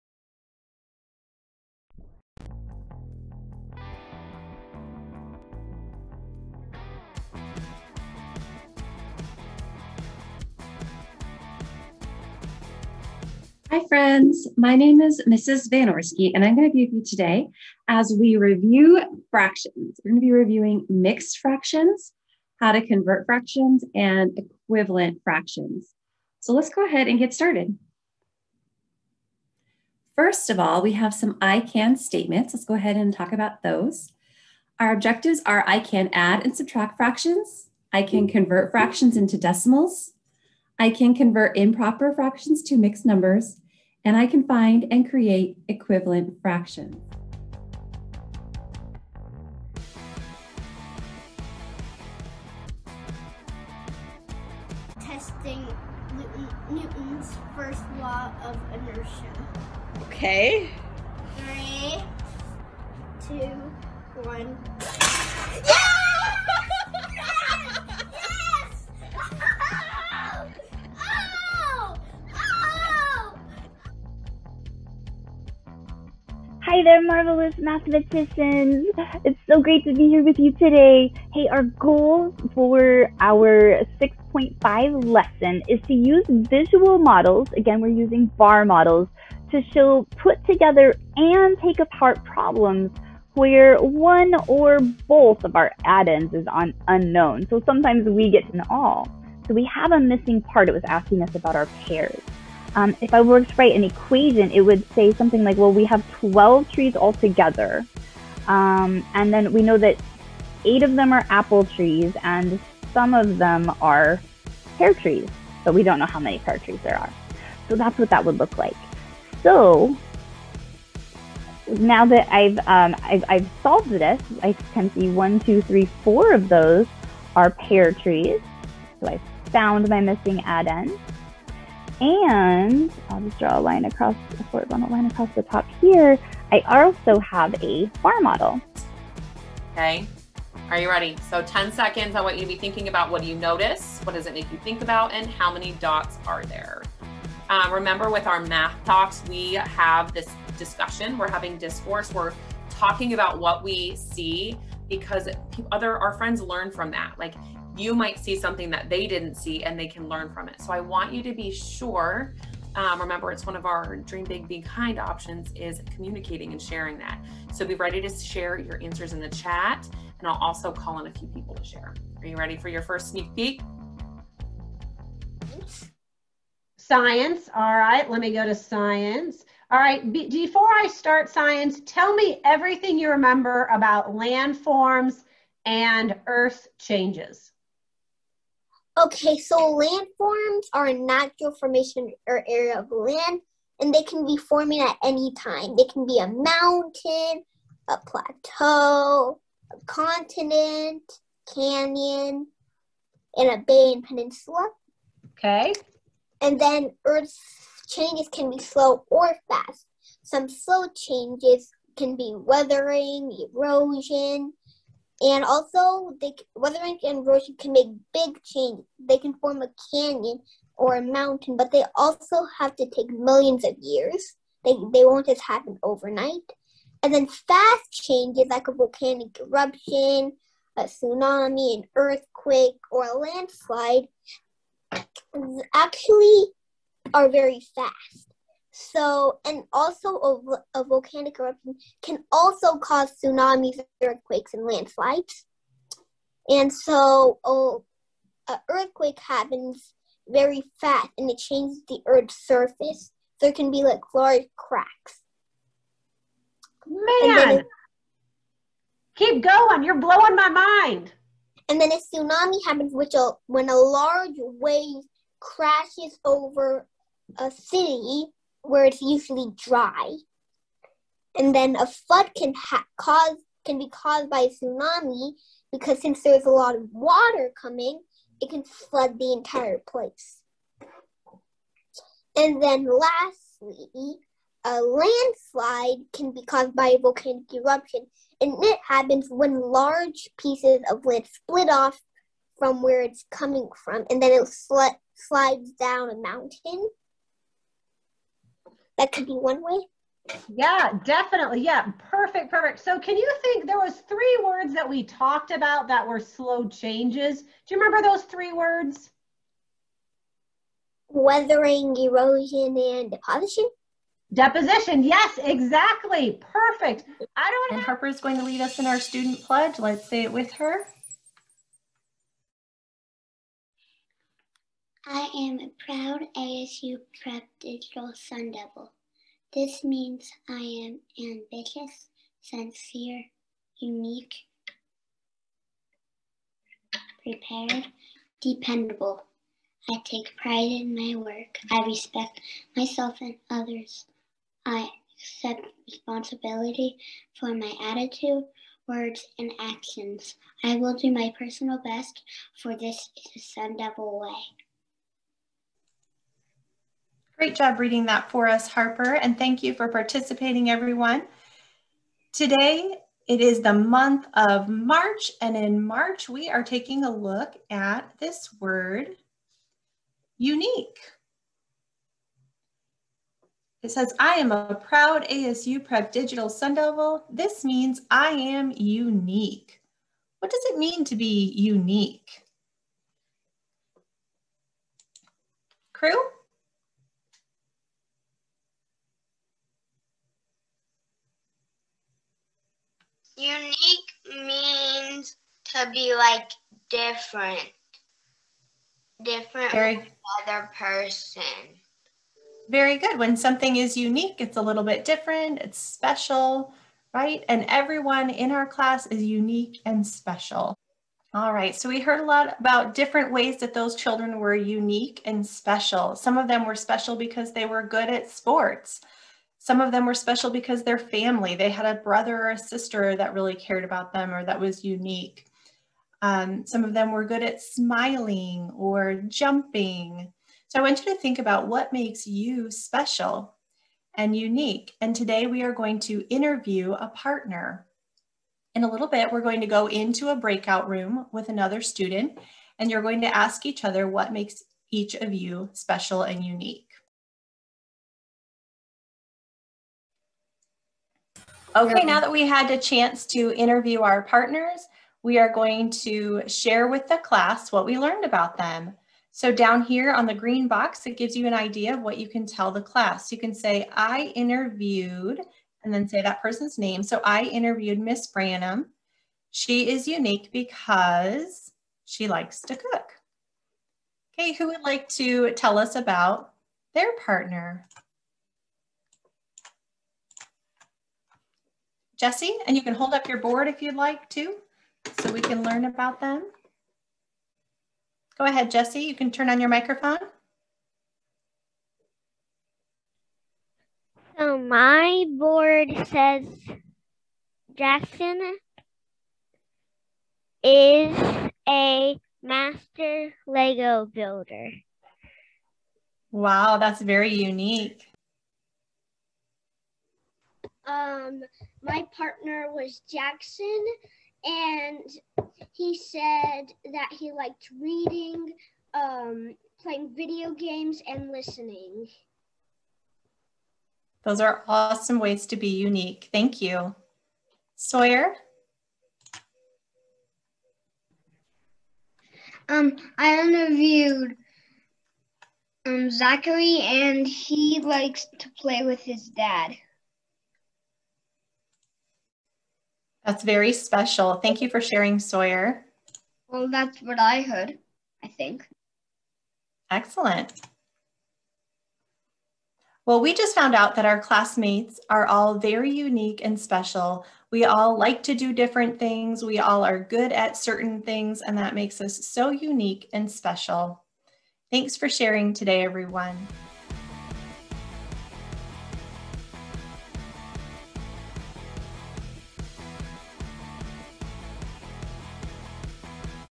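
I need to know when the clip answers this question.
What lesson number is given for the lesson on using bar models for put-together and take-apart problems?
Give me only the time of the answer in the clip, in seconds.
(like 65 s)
83 s.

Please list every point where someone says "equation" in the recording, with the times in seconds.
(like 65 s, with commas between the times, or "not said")
103 s.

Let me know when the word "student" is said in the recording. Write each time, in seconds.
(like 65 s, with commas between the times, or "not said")
318 s, 441 s.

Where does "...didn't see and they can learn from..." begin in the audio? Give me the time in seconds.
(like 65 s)
159 s.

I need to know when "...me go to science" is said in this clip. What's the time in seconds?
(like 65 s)
178 s.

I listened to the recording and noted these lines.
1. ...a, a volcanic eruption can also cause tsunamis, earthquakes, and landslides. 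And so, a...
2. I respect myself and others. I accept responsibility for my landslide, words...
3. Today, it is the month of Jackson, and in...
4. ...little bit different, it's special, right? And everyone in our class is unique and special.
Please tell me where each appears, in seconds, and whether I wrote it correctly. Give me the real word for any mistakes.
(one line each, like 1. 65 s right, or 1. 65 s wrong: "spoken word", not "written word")
1. 240 s right
2. 341 s wrong: "attitude", not "landslide"
3. 362 s wrong: "March", not "Jackson"
4. 404 s right.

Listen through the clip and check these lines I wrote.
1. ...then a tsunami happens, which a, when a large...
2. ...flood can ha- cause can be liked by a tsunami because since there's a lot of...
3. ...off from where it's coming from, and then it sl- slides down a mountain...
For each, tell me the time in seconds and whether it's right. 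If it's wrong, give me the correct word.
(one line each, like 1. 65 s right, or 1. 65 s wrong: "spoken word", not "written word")
1. 261 s right
2. 271 s wrong: "caused", not "liked"
3. 291 s right.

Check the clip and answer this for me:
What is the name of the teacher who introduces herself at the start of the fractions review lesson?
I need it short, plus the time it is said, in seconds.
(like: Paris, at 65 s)
Mrs. Vanorsky, at 15 s.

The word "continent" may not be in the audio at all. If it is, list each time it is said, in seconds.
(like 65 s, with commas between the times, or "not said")
199 s.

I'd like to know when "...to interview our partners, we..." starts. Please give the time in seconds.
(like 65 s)
453 s.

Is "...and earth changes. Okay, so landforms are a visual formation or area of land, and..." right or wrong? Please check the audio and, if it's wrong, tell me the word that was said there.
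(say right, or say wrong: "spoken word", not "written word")
wrong: "natural", not "visual".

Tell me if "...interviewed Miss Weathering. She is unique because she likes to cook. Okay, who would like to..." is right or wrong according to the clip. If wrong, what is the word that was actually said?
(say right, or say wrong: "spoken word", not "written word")
wrong: "Branham", not "Weathering".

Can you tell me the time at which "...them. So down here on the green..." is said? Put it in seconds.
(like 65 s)
458 s.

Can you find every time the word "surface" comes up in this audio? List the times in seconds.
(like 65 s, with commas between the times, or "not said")
252 s.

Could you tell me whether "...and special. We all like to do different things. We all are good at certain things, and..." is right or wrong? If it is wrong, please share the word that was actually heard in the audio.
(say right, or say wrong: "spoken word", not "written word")
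right.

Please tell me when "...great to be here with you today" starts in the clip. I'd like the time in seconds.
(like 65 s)
79 s.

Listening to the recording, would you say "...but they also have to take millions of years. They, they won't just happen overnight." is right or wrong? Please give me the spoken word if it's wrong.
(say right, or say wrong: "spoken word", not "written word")
right.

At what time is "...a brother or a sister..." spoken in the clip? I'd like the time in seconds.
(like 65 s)
421 s.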